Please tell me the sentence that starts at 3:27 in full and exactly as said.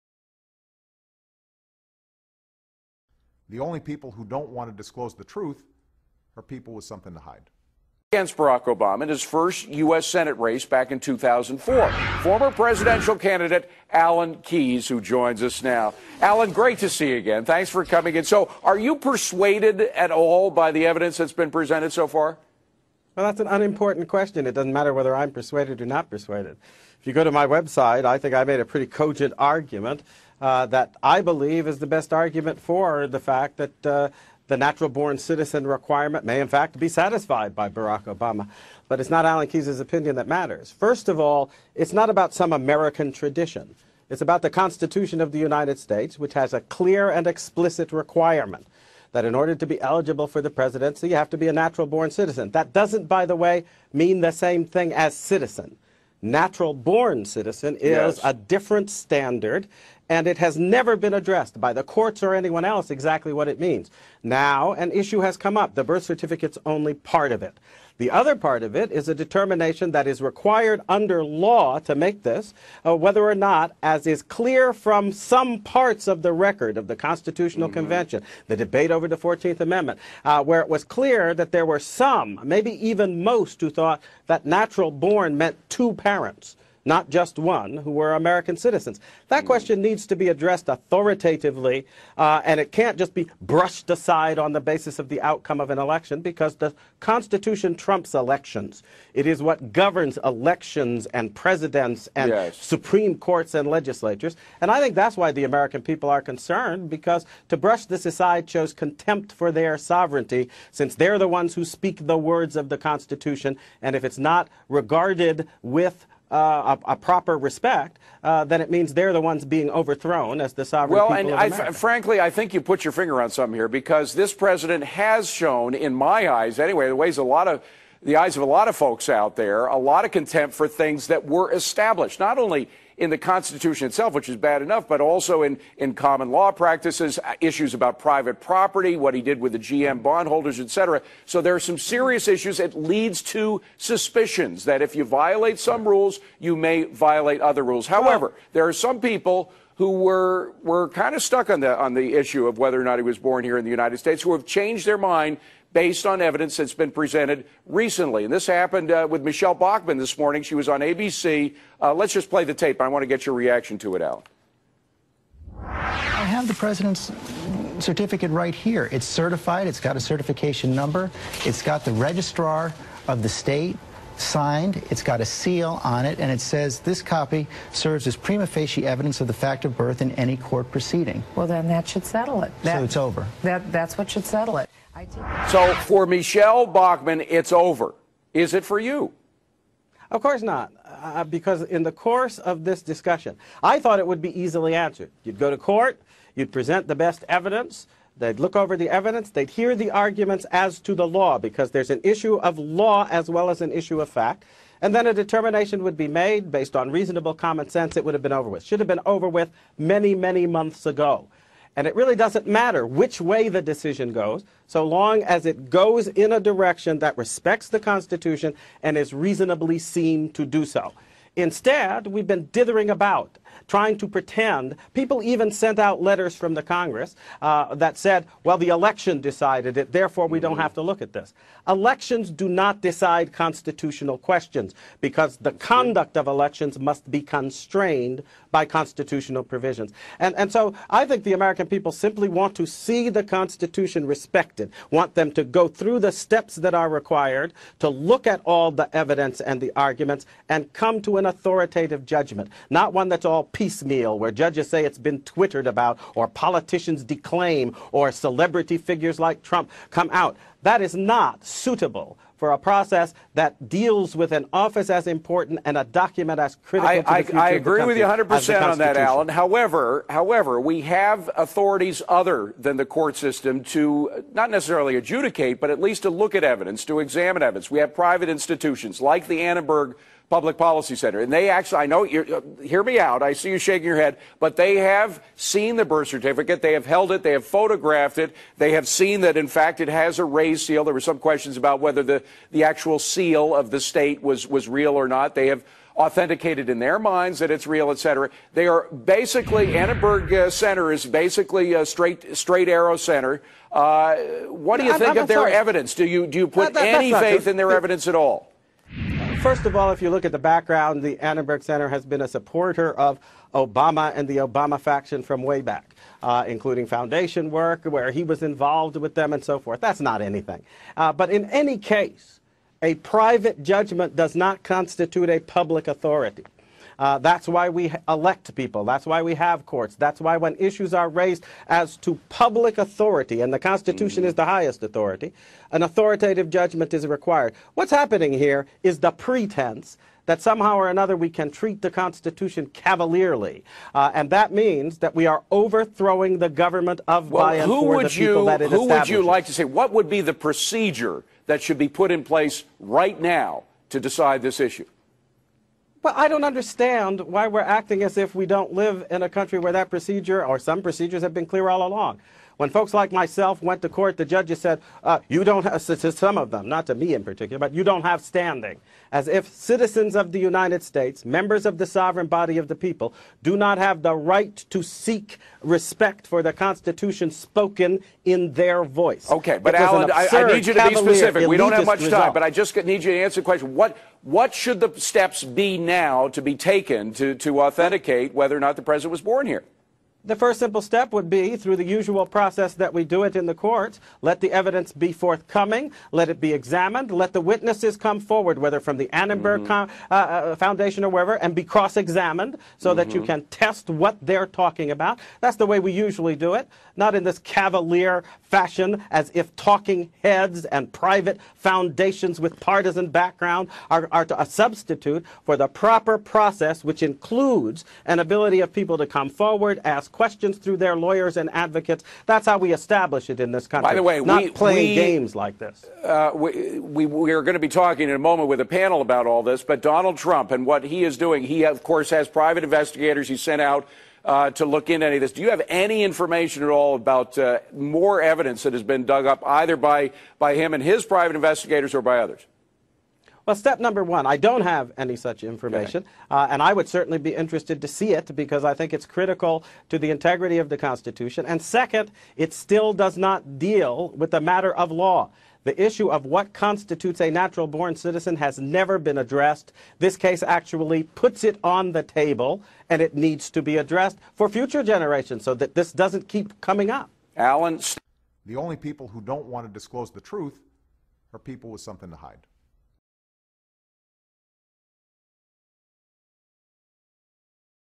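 It would have been over with.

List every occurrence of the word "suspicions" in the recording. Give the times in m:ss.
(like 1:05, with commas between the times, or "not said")
2:23.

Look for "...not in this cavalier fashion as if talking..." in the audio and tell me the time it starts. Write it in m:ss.
6:46.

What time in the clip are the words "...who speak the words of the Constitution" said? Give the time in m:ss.
1:51.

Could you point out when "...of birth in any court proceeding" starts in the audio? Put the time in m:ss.
2:59.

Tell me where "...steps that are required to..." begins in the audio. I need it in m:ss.
4:06.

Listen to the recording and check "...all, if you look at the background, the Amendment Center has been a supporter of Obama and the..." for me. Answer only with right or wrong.
wrong.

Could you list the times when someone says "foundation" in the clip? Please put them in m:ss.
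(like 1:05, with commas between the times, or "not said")
5:16, 6:40, 6:51.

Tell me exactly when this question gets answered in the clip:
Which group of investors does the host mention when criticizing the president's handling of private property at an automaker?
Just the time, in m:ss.
2:19.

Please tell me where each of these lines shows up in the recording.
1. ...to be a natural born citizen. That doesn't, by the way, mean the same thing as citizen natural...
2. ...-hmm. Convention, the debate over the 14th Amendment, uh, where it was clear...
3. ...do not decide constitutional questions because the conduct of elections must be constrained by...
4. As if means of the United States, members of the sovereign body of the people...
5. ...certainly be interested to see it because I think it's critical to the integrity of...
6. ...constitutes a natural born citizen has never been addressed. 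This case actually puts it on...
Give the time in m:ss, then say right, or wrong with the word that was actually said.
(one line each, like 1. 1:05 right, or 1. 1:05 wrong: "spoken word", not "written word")
1. 0:51 right
2. 1:17 right
3. 3:52 right
4. 6:09 wrong: "citizens", not "means"
5. 7:26 right
6. 7:36 right.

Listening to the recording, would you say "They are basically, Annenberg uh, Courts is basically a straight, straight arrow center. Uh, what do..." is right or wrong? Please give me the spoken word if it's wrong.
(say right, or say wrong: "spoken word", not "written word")
wrong: "Center", not "Courts".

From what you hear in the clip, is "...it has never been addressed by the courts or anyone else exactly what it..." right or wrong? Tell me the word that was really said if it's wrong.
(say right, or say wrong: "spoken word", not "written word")
right.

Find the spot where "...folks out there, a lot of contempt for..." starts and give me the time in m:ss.
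2:08.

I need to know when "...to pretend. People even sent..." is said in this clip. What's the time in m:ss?
3:43.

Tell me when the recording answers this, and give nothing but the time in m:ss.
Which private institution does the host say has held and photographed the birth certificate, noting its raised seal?
4:39.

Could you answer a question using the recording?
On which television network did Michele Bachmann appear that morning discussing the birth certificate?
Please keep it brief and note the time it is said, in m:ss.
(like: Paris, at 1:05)
ABC, at 2:40.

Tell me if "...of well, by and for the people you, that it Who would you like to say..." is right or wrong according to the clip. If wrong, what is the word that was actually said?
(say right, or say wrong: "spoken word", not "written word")
right.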